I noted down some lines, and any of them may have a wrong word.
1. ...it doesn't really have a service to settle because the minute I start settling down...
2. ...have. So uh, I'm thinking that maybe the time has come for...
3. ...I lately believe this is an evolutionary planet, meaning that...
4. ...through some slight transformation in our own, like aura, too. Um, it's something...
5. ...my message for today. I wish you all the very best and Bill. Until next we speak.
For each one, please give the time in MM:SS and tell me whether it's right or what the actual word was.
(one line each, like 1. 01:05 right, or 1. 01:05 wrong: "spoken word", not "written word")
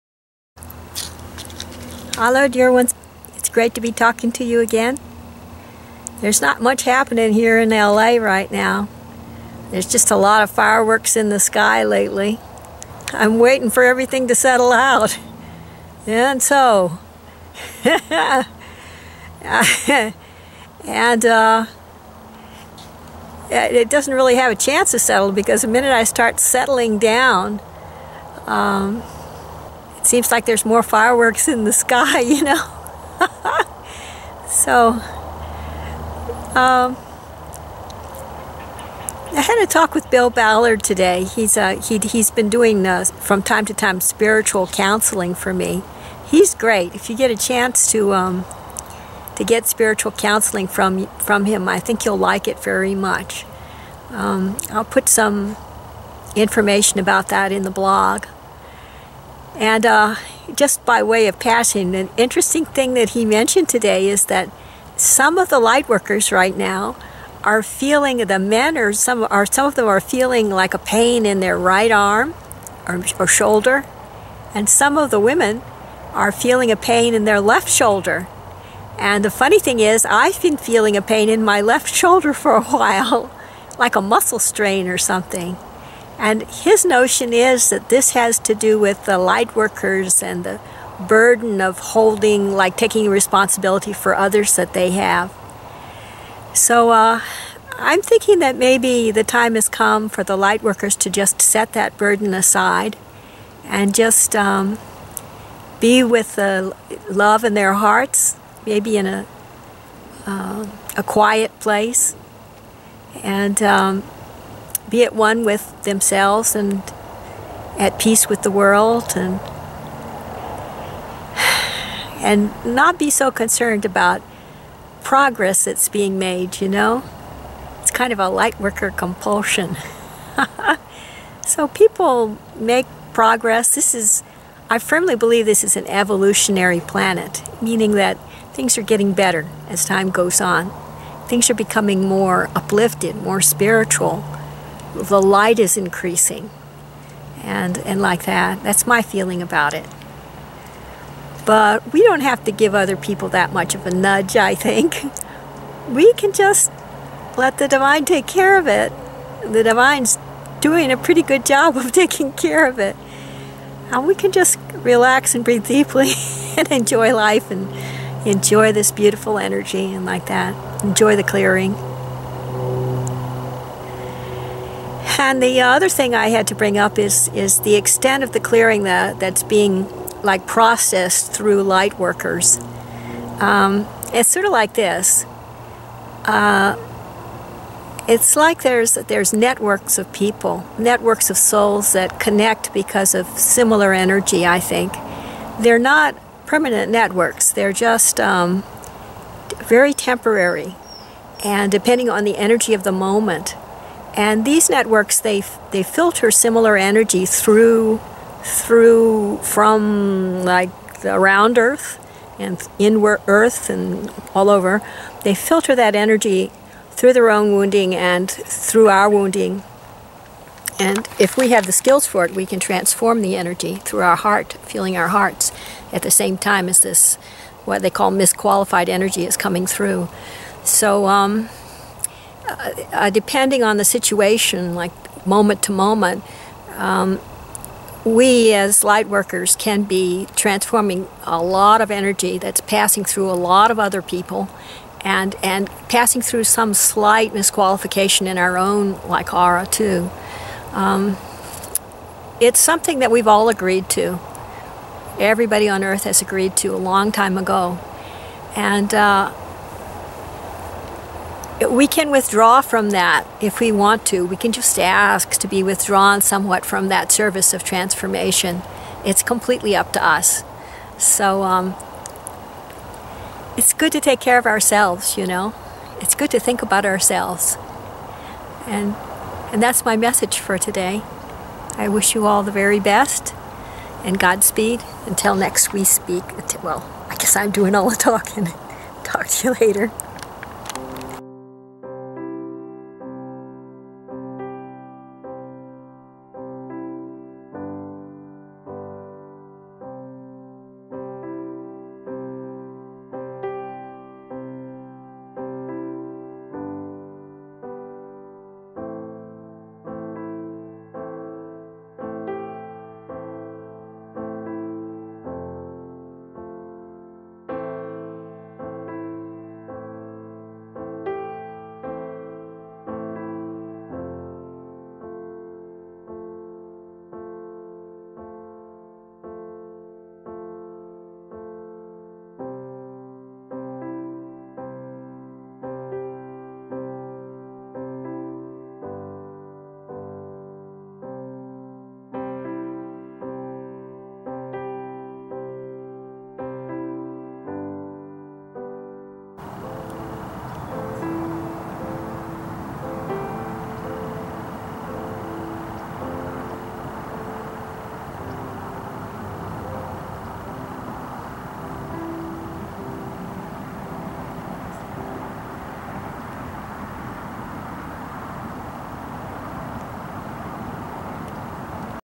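1. 00:23 wrong: "chance", not "service"
2. 01:34 right
3. 02:14 wrong: "firmly", not "lately"
4. 04:06 wrong: "misqualification", not "transformation"
5. 04:39 wrong: "Godspeed", not "Bill".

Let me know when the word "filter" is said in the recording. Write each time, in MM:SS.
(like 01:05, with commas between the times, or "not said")
03:25, 03:35.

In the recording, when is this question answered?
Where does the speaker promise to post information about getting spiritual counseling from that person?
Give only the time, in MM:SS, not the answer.
00:57.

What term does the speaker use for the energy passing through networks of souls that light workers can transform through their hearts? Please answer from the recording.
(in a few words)
Misqualified energy.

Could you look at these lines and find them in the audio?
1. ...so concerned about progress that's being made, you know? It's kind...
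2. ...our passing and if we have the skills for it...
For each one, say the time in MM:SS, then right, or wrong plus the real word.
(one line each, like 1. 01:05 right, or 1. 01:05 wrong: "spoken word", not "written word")
1. 02:03 right
2. 03:38 wrong: "wounding", not "passing".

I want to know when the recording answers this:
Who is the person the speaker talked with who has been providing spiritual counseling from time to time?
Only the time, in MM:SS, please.
00:40.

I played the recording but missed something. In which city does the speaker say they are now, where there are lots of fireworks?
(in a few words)
LA.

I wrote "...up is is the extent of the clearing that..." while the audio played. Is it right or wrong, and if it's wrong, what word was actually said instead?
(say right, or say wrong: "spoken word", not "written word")
right.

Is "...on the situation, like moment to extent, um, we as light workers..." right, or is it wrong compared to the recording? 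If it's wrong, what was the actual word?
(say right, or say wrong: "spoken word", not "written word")
wrong: "moment", not "extent".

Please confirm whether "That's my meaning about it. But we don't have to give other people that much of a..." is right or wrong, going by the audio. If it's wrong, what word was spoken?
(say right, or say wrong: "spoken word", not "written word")
wrong: "feeling", not "meaning".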